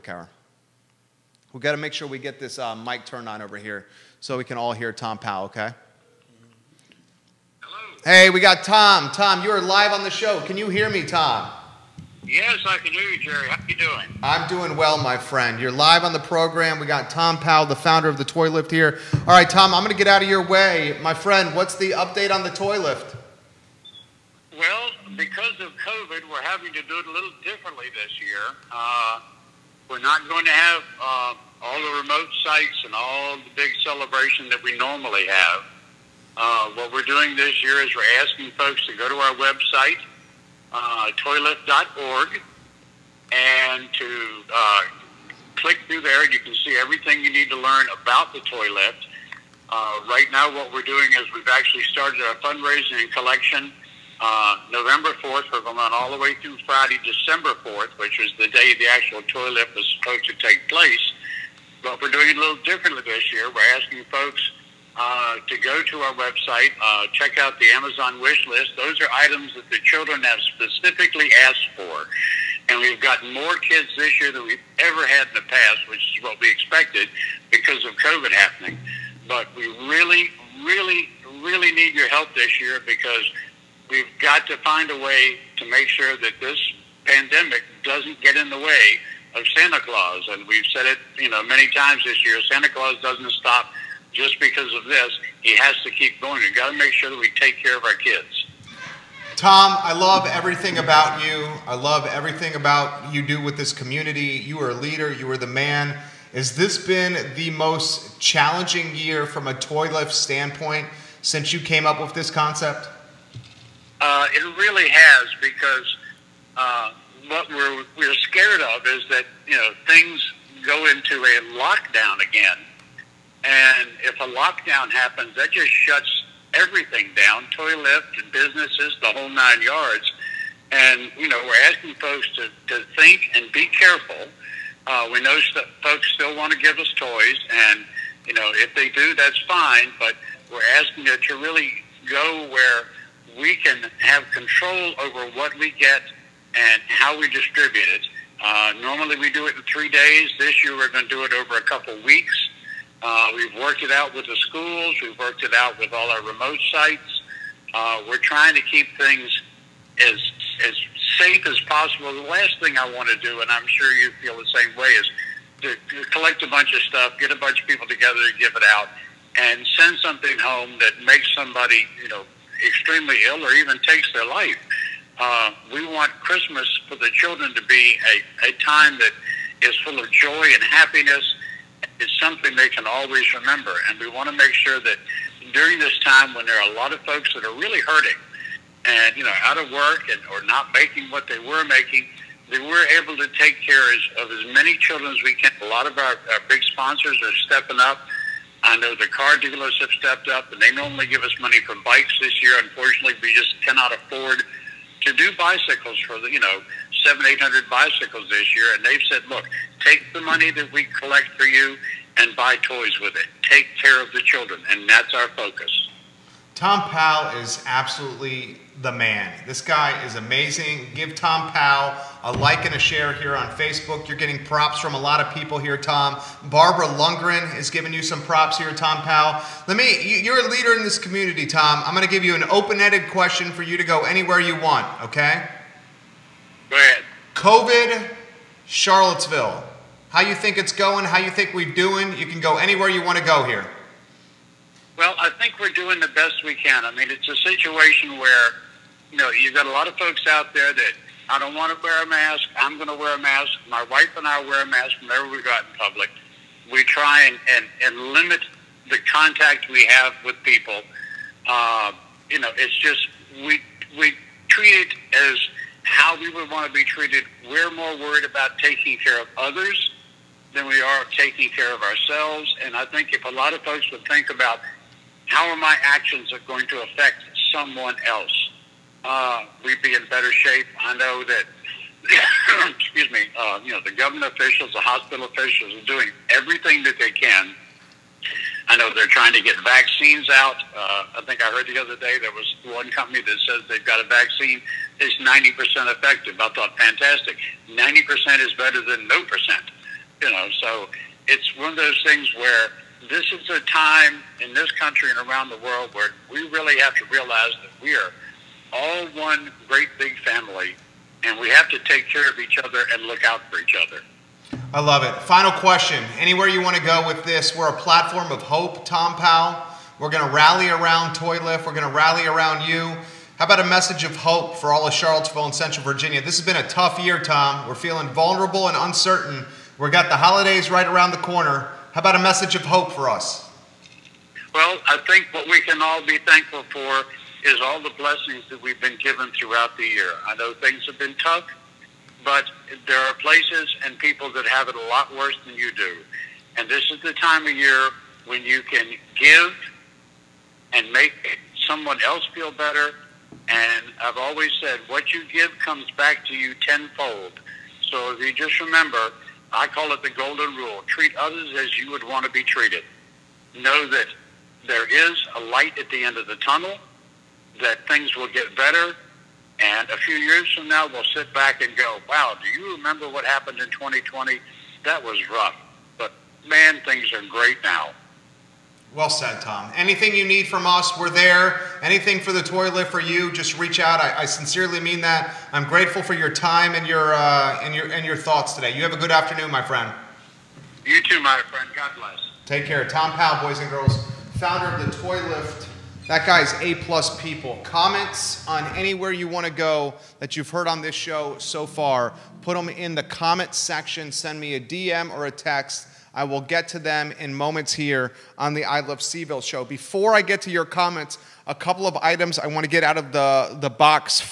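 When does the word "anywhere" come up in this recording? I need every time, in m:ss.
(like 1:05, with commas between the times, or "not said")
3:54, 4:02, 5:16, 6:38.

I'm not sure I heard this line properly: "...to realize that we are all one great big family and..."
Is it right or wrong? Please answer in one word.
right.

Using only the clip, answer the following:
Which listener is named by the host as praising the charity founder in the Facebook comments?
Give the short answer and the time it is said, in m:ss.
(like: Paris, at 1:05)
Barbara Lundgren, at 3:46.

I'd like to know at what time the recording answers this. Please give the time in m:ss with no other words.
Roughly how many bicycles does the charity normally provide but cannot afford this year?
3:27.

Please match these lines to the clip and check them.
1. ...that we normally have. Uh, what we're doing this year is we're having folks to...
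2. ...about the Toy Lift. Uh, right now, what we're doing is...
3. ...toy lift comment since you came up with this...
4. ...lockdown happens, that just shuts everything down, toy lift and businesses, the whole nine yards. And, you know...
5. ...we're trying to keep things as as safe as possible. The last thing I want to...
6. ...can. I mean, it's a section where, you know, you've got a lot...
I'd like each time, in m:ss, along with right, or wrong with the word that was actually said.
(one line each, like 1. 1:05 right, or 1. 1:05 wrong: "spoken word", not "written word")
1. 0:34 wrong: "asking", not "having"
2. 0:48 right
3. 1:49 wrong: "standpoint", not "comment"
4. 2:04 right
5. 2:38 right
6. 4:06 wrong: "situation", not "section".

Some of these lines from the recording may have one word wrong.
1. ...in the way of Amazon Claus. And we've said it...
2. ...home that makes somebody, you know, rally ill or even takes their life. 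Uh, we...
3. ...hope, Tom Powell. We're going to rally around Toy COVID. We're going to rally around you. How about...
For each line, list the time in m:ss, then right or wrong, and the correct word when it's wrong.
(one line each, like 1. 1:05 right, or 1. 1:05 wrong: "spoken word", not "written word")
1. 1:28 wrong: "Santa", not "Amazon"
2. 2:50 wrong: "extremely", not "rally"
3. 5:18 wrong: "Lift", not "COVID".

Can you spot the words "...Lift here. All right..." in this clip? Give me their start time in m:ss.
0:18.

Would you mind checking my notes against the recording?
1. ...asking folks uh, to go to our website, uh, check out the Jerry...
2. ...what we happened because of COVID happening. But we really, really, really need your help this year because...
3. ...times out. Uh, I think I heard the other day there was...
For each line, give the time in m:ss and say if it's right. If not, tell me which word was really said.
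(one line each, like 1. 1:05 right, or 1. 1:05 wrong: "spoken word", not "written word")
1. 1:03 wrong: "Amazon", not "Jerry"
2. 1:16 wrong: "expected", not "happened"
3. 4:49 wrong: "vaccines", not "times".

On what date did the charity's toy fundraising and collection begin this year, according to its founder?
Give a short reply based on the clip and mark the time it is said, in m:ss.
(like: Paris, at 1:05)
November 4, at 0:54.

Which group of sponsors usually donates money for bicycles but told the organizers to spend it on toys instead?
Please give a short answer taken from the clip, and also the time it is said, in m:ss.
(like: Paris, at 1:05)
car dealers, at 3:19.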